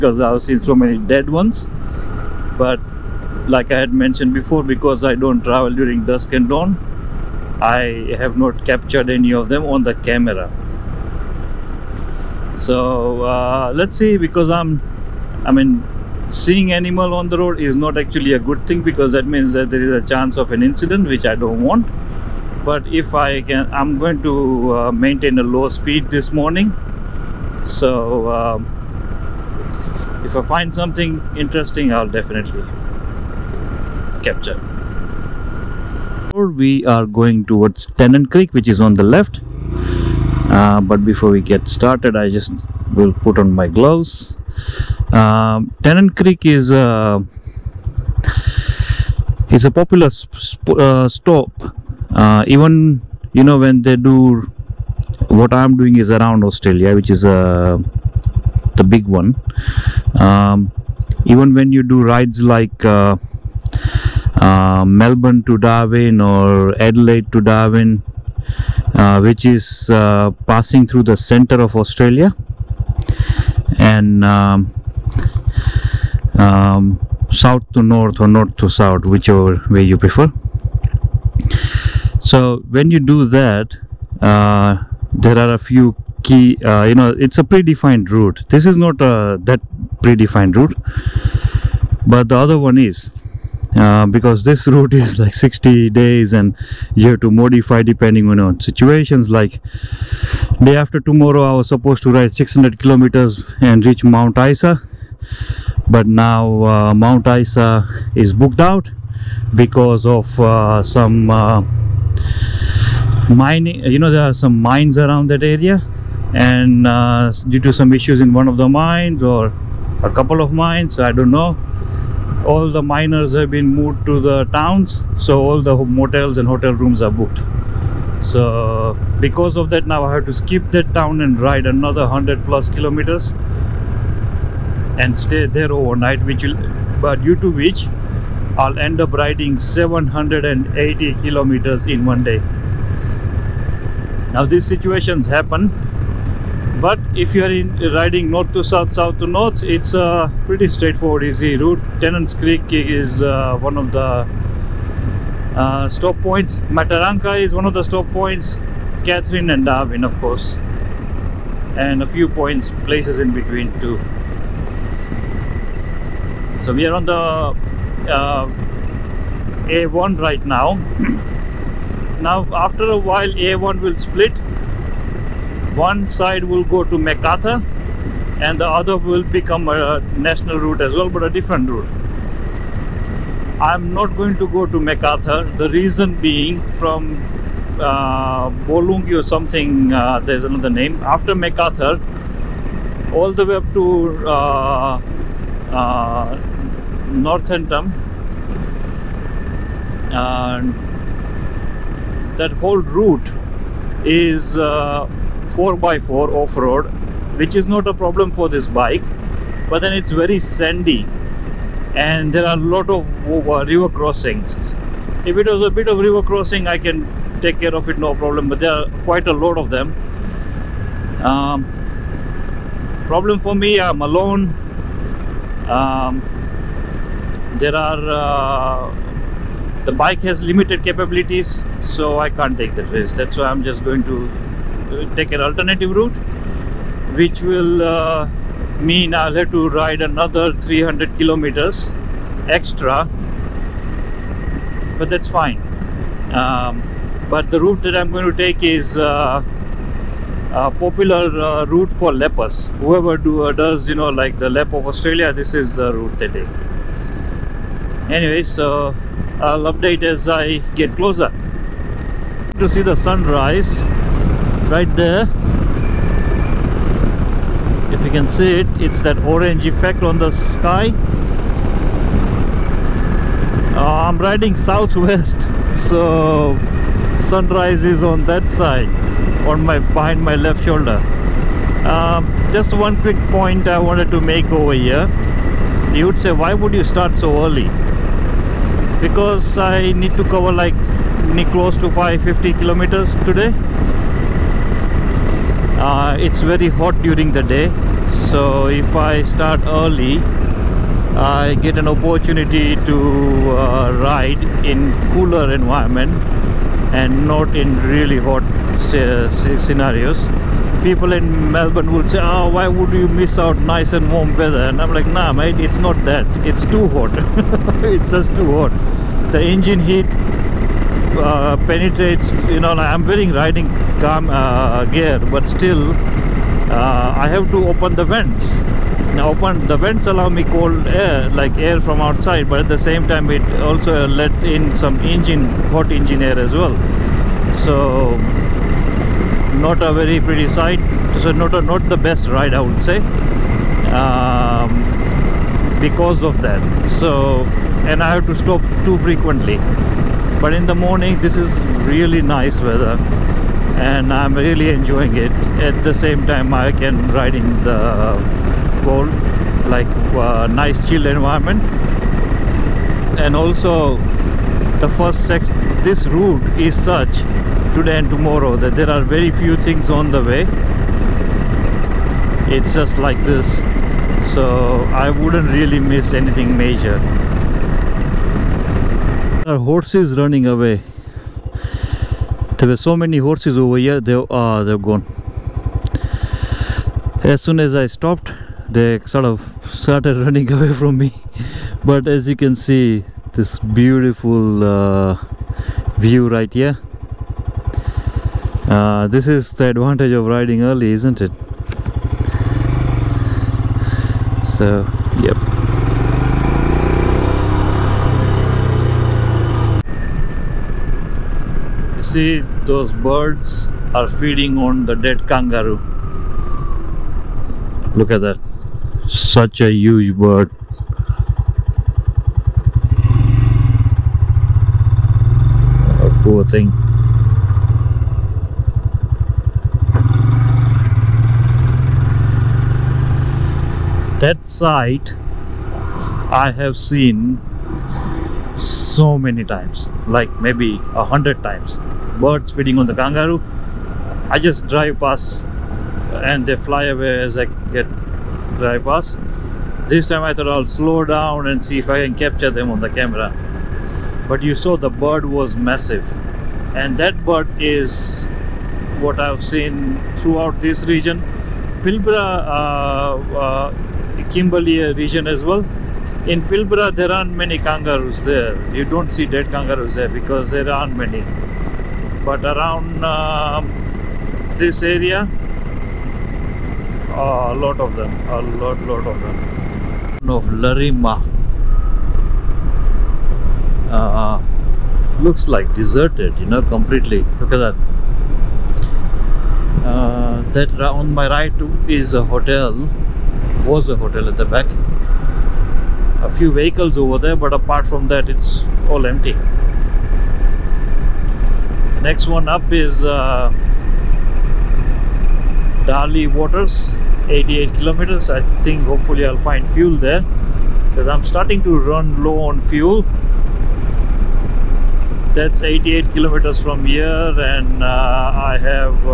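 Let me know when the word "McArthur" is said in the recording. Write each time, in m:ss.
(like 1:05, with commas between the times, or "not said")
2:56, 3:04, 3:11.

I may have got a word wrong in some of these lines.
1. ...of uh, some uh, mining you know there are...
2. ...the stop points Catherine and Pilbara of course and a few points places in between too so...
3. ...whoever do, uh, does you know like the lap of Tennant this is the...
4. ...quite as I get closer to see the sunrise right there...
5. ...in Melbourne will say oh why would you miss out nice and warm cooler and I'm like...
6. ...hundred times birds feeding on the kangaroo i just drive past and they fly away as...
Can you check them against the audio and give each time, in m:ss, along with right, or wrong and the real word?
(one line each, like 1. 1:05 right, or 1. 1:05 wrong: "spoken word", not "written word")
1. 1:50 right
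2. 2:37 wrong: "Darwin", not "Pilbara"
3. 4:12 wrong: "Australia", not "Tennant"
4. 4:19 wrong: "update", not "quite"
5. 5:11 wrong: "weather", not "cooler"
6. 7:21 right.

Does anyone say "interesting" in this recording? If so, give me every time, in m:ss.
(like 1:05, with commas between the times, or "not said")
0:31.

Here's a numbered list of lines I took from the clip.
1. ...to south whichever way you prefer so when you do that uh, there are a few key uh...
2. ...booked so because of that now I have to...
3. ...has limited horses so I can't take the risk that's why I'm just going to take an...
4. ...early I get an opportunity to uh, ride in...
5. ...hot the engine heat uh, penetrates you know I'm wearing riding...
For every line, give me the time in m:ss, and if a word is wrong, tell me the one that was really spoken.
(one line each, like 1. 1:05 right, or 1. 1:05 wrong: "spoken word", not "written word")
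1. 1:18 right
2. 2:07 right
3. 3:50 wrong: "capabilities", not "horses"
4. 4:59 right
5. 5:18 right.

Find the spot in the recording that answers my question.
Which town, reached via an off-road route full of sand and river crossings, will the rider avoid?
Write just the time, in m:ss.
3:17.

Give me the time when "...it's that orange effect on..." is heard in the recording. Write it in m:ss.
4:28.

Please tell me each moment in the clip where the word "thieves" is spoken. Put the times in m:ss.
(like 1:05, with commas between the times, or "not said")
not said.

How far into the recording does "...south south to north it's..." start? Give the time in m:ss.
2:28.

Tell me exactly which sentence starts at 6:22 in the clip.
There were so many horses over here.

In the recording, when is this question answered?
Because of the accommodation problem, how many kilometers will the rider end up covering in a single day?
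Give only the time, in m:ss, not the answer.
2:19.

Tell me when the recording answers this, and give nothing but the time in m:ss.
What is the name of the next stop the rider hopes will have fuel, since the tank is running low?
8:26.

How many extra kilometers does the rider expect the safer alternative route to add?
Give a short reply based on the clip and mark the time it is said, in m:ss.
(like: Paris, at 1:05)
300, at 4:00.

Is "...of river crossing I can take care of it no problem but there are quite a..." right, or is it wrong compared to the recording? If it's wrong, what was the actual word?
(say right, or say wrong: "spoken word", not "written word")
right.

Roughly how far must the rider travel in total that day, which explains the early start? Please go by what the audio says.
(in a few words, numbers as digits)
550 km.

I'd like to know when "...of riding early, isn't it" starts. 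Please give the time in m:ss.
6:40.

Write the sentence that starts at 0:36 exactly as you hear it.
We are going towards Tennant Creek which is on the left.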